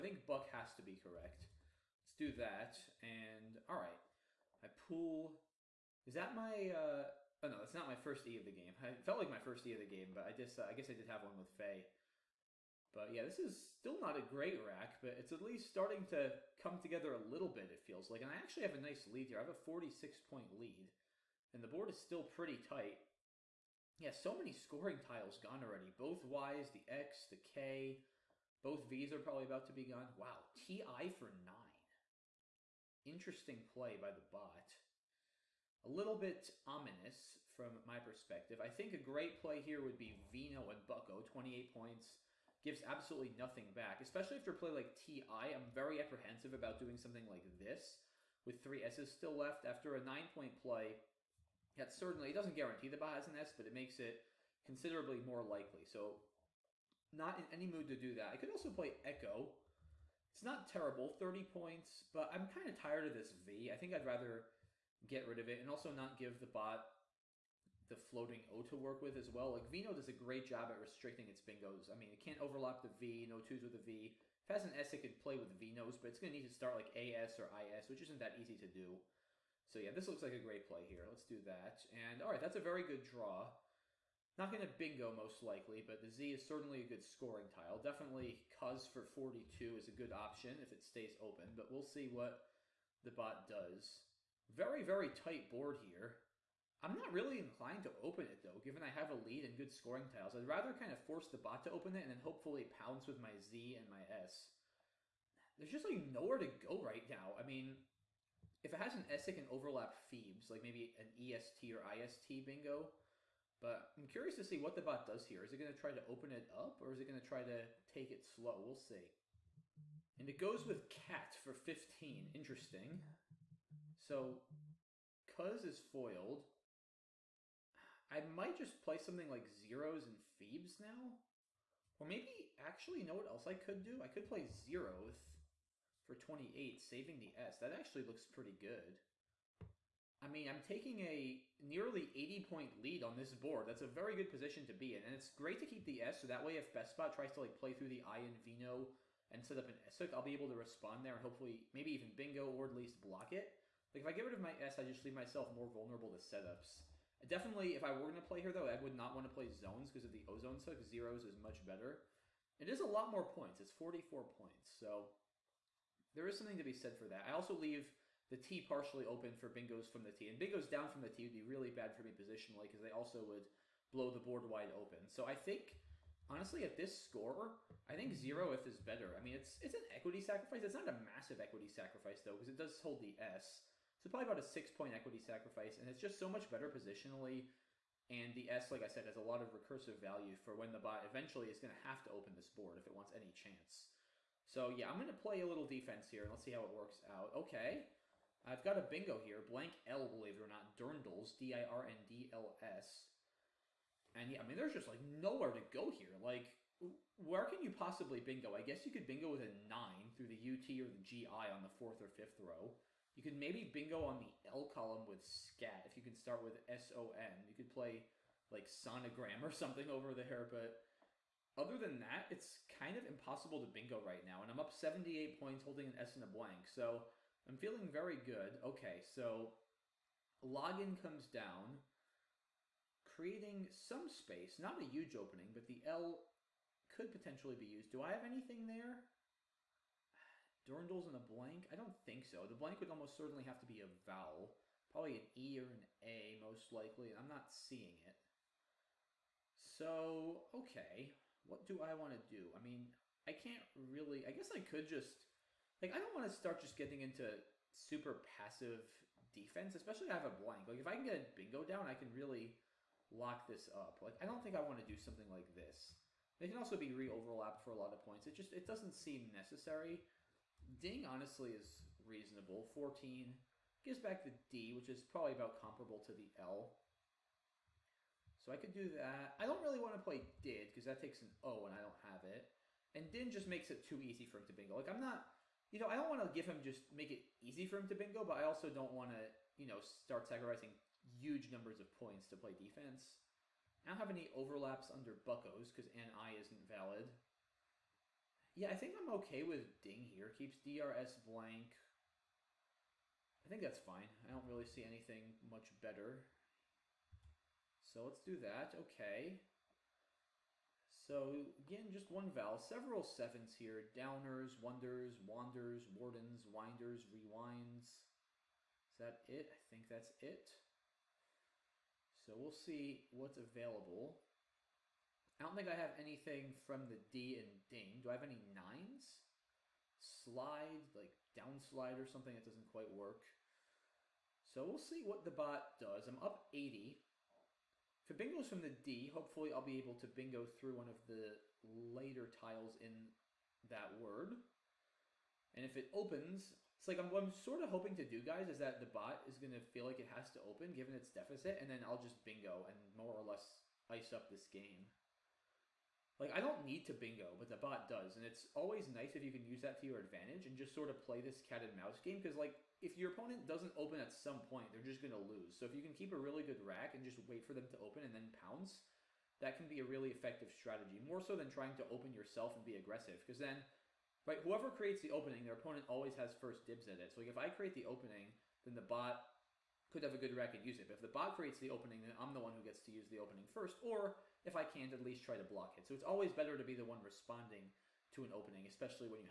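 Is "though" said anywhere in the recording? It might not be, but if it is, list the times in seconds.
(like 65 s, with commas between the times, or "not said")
98 s, 158 s, 182 s.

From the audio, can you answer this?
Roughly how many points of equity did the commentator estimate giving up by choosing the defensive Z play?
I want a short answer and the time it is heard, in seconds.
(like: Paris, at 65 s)
6, at 184 s.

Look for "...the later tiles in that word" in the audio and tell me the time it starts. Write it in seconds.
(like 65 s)
341 s.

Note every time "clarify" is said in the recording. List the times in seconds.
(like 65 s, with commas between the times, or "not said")
not said.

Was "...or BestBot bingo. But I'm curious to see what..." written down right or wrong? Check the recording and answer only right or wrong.
wrong.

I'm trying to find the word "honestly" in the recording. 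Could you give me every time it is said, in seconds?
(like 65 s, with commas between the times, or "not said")
176 s, 271 s.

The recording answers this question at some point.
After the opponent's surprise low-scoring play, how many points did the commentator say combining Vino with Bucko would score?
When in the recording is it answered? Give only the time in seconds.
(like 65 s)
41 s.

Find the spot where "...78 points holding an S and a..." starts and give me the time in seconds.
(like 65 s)
224 s.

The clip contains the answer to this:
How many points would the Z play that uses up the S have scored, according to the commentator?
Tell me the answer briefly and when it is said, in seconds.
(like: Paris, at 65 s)
44, at 163 s.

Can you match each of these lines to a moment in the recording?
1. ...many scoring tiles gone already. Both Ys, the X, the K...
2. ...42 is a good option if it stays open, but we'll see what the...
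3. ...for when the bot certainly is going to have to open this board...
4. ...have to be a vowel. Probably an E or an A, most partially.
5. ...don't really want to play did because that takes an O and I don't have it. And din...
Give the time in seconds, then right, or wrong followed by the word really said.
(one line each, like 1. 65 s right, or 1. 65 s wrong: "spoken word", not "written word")
1. 24 s right
2. 89 s right
3. 190 s wrong: "eventually", not "certainly"
4. 243 s wrong: "likely", not "partially"
5. 279 s right.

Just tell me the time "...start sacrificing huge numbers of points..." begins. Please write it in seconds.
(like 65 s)
289 s.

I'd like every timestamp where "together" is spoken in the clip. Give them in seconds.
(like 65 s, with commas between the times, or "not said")
16 s.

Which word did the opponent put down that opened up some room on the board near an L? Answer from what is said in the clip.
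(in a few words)
Login.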